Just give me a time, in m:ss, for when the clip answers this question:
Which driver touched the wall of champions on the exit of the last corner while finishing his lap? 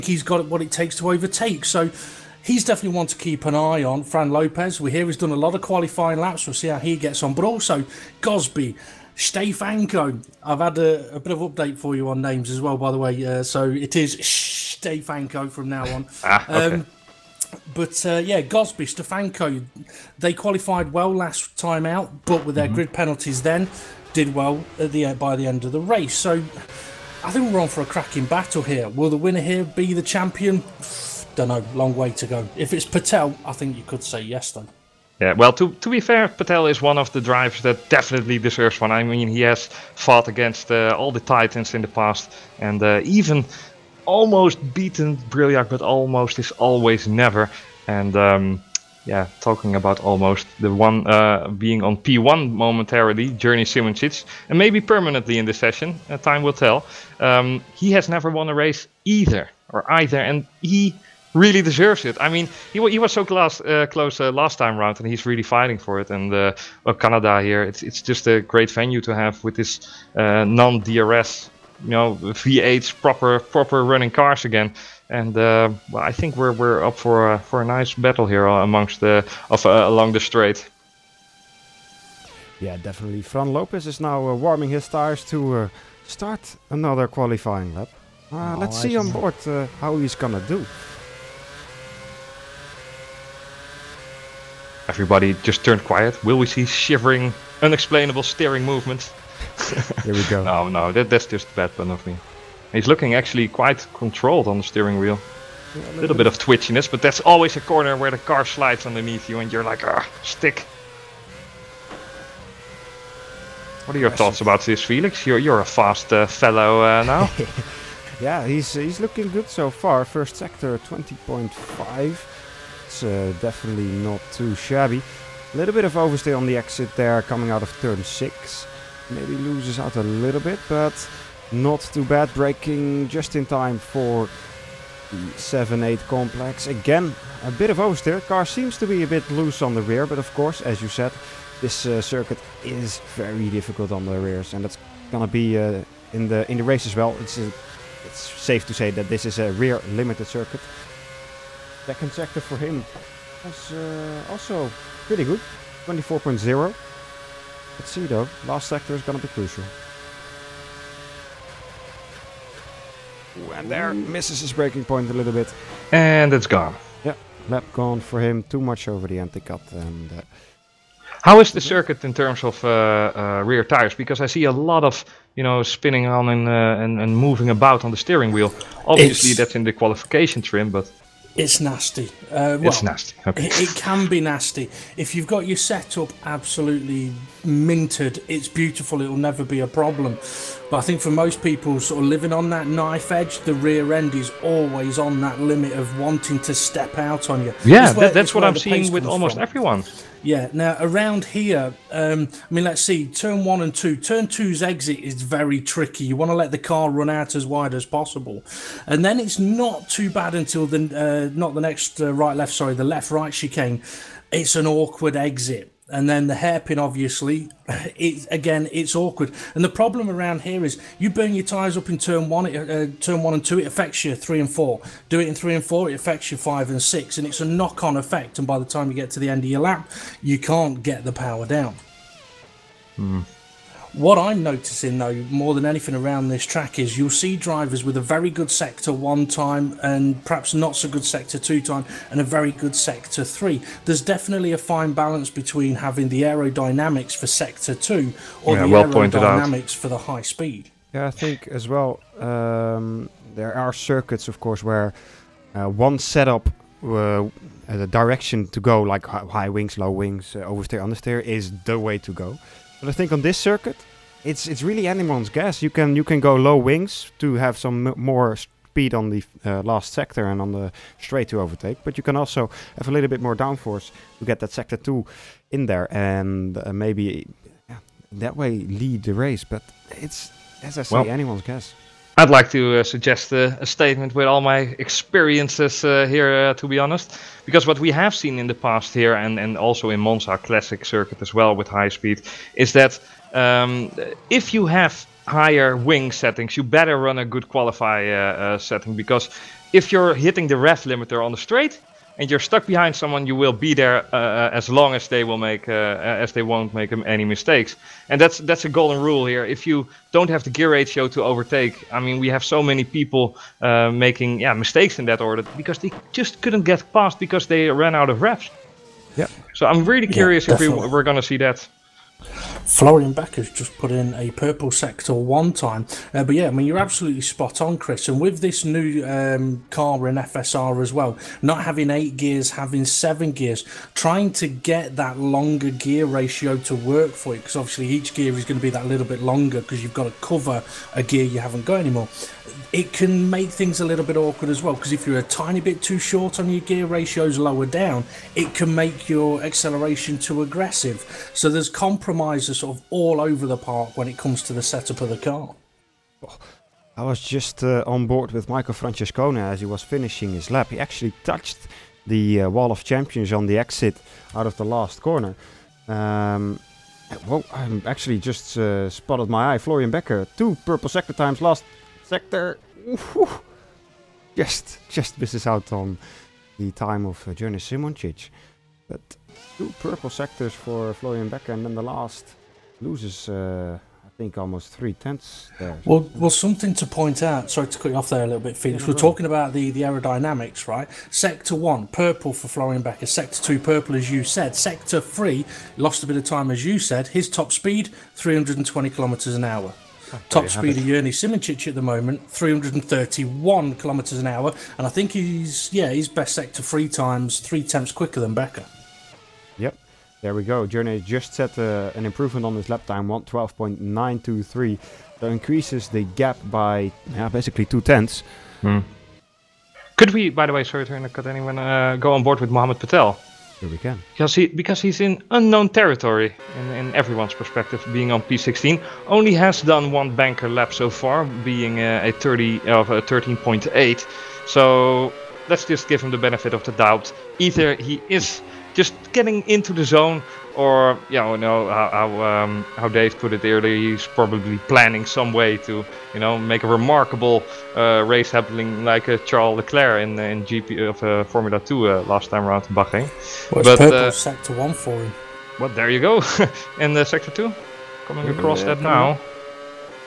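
5:58.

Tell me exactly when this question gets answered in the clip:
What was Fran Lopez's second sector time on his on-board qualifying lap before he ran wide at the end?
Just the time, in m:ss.
2:35.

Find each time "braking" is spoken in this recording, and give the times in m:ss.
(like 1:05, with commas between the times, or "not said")
2:12, 2:44.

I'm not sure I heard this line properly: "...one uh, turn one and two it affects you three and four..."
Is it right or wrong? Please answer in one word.
right.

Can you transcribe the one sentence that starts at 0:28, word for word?
Will the winner here be the champion?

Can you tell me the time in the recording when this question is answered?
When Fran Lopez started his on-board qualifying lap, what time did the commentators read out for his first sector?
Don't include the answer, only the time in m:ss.
2:00.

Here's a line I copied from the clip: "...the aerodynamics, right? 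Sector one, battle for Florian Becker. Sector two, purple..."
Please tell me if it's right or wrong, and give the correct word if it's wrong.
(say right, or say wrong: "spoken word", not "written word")
wrong: "purple", not "battle".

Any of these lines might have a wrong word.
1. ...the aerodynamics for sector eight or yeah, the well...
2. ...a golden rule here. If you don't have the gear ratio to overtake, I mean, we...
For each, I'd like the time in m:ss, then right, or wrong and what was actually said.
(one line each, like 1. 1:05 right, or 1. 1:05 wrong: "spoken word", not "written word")
1. 4:06 wrong: "two", not "eight"
2. 5:08 right.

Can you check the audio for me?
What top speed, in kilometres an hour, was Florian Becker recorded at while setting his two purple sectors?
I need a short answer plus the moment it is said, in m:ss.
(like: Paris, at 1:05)
320, at 6:38.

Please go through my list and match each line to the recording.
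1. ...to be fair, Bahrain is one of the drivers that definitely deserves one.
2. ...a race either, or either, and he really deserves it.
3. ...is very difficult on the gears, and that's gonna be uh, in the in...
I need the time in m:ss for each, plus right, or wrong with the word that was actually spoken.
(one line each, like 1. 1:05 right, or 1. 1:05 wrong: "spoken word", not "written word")
1. 0:35 wrong: "Patel", not "Bahrain"
2. 0:58 right
3. 2:22 wrong: "rears", not "gears".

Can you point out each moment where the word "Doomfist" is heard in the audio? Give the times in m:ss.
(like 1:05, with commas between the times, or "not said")
not said.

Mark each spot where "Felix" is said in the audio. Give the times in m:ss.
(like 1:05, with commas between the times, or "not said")
1:54, 6:28.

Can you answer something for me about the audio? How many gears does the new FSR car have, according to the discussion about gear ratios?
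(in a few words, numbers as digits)
7.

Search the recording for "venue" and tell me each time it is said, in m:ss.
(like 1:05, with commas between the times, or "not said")
1:08.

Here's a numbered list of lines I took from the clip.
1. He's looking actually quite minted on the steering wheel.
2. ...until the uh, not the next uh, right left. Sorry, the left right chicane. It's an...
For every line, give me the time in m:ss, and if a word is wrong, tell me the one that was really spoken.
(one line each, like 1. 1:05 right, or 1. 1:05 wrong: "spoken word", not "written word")
1. 1:42 wrong: "controlled", not "minted"
2. 3:30 right.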